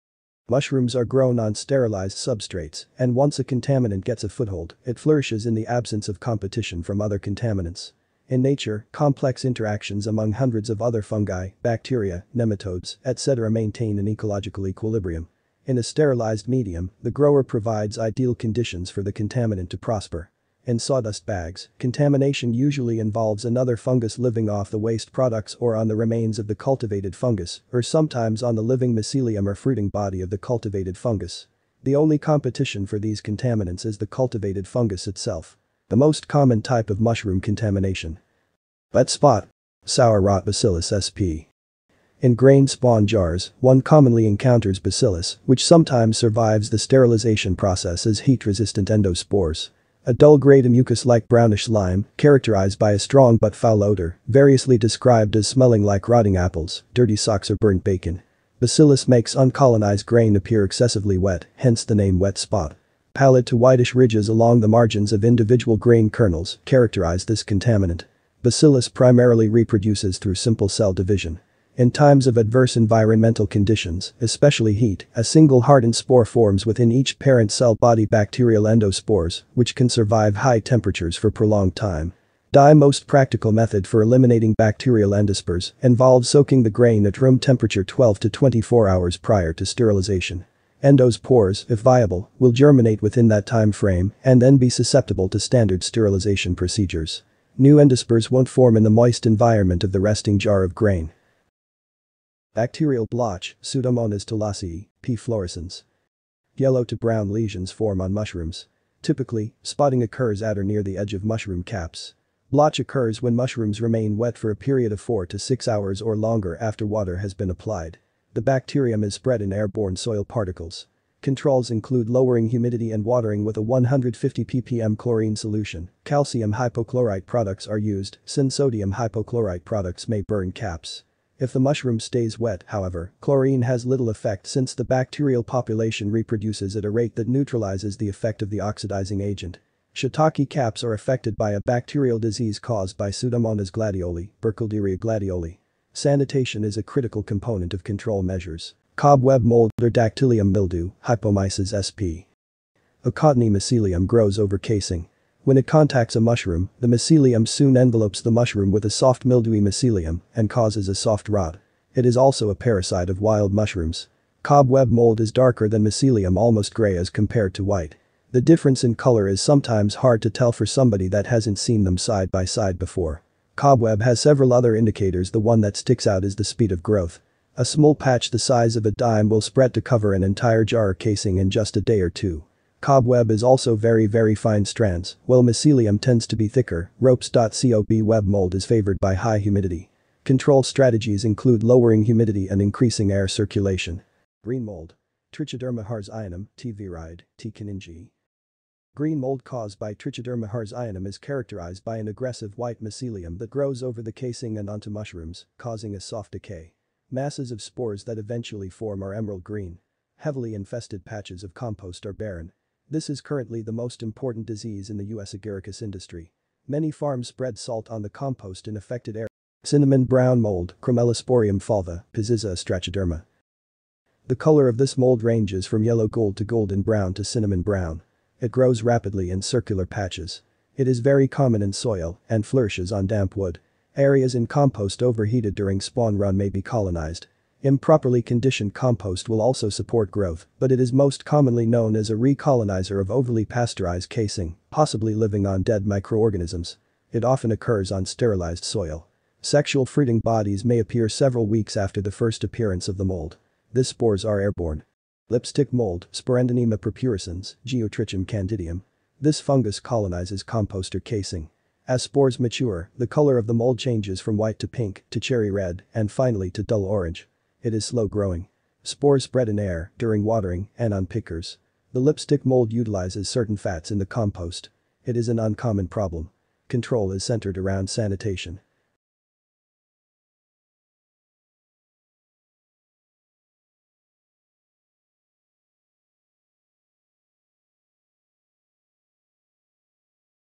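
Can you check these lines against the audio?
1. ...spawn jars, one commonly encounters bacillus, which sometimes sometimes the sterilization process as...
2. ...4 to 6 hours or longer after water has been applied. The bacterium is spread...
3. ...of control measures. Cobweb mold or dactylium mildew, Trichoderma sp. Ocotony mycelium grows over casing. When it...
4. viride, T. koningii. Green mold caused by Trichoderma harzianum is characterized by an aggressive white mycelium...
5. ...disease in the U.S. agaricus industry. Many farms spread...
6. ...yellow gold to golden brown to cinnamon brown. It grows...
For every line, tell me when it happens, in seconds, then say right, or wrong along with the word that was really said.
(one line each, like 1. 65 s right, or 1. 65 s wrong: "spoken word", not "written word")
1. 42 s wrong: "survives", not "sometimes"
2. 114 s right
3. 147 s wrong: "Hypomyces", not "Trichoderma"
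4. 196 s right
5. 214 s right
6. 225 s right.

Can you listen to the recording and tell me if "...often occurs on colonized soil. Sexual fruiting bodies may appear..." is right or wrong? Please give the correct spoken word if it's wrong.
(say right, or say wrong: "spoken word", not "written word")
wrong: "sterilized", not "colonized".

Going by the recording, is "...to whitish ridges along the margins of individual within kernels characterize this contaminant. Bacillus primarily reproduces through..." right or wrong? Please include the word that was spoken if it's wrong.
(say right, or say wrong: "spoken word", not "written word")
wrong: "grain", not "within".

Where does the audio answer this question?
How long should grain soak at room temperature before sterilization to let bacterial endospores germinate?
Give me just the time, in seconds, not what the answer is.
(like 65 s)
87 s.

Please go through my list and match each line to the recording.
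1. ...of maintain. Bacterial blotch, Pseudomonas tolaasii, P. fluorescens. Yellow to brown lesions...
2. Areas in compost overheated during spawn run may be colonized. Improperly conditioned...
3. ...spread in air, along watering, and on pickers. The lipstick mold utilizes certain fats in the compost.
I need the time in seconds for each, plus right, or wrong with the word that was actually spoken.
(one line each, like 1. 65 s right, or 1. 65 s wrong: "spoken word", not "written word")
1. 100 s wrong: "grain", not "maintain"
2. 233 s right
3. 269 s wrong: "during", not "along".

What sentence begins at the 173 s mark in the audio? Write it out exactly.
Cobweb has several other indicators the one that sticks out is the speed of growth.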